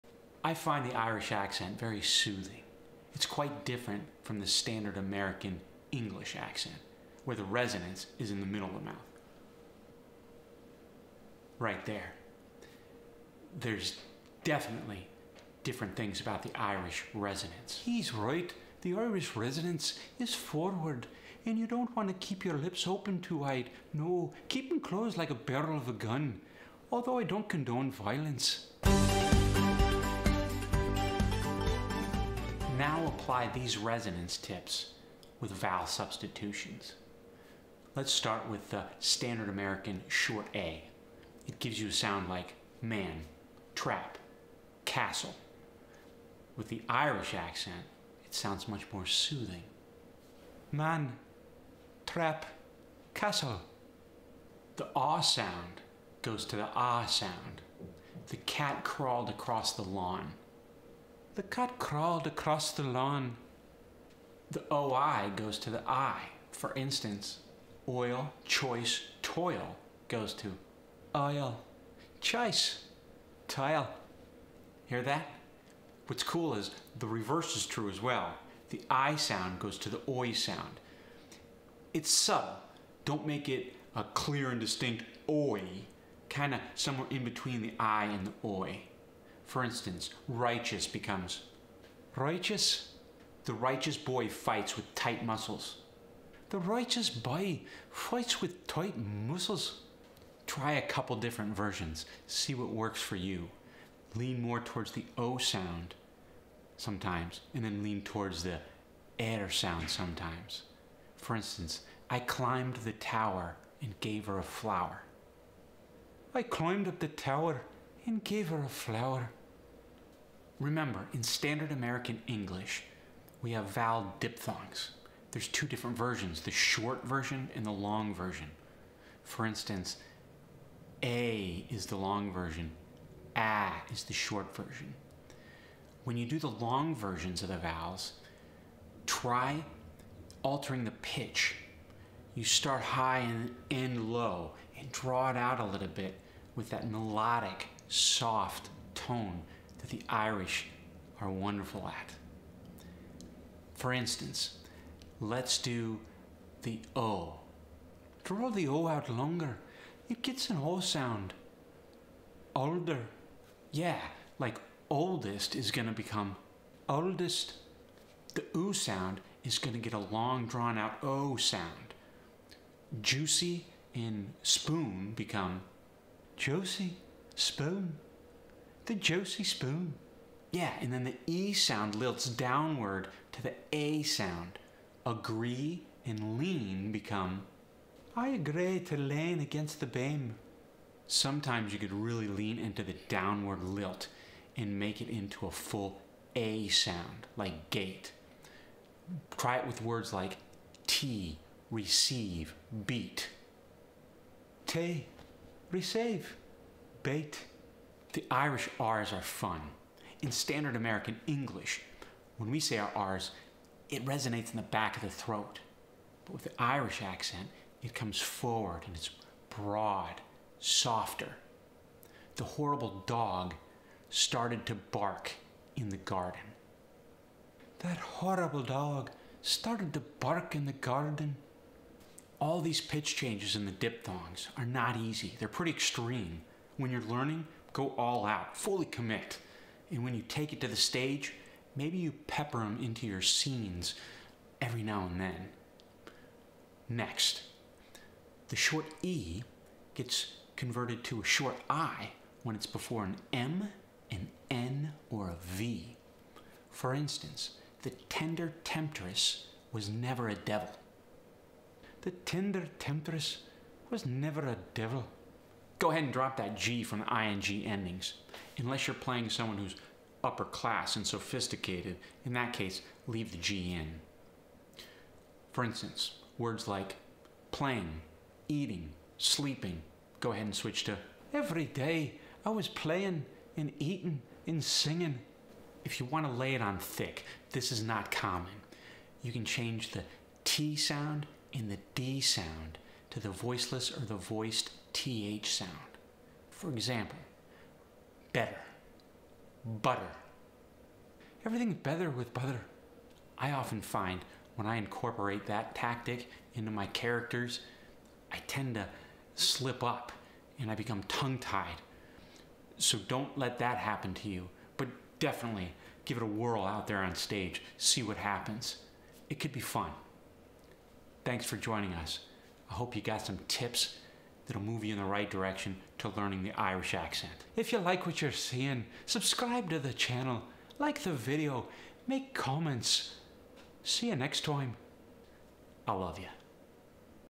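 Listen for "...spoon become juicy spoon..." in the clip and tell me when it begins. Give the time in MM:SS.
02:54.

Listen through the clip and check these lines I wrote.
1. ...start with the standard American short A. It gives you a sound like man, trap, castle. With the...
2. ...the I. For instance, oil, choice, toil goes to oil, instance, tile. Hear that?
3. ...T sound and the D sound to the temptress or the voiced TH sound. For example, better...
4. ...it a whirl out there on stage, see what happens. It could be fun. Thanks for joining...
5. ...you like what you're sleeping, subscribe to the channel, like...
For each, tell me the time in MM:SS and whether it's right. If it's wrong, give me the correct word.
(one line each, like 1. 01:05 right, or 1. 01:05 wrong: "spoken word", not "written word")
1. 00:38 right
2. 01:05 wrong: "choice", not "instance"
3. 04:50 wrong: "voiceless", not "temptress"
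4. 05:16 right
5. 05:27 wrong: "seeing", not "sleeping".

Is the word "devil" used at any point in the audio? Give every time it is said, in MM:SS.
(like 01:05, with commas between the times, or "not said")
04:20, 04:24.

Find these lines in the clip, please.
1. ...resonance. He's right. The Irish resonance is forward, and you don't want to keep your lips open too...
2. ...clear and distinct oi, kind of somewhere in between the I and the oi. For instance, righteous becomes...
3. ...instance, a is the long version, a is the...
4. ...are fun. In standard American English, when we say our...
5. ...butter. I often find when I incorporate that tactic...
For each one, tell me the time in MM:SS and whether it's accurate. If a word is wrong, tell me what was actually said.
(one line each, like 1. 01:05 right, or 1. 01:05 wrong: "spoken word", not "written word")
1. 00:17 right
2. 01:24 right
3. 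02:09 right
4. 03:29 right
5. 05:02 right.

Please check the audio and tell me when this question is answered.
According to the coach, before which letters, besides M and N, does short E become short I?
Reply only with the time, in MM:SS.
04:15.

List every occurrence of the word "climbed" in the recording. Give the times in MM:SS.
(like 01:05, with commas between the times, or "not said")
01:52, 01:56.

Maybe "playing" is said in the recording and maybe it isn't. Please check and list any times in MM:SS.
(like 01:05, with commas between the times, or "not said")
04:28, 04:37, 04:42.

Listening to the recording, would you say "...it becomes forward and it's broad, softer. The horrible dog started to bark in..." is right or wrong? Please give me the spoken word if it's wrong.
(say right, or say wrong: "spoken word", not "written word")
wrong: "comes", not "becomes".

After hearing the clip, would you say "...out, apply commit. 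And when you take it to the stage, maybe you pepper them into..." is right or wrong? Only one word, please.
wrong.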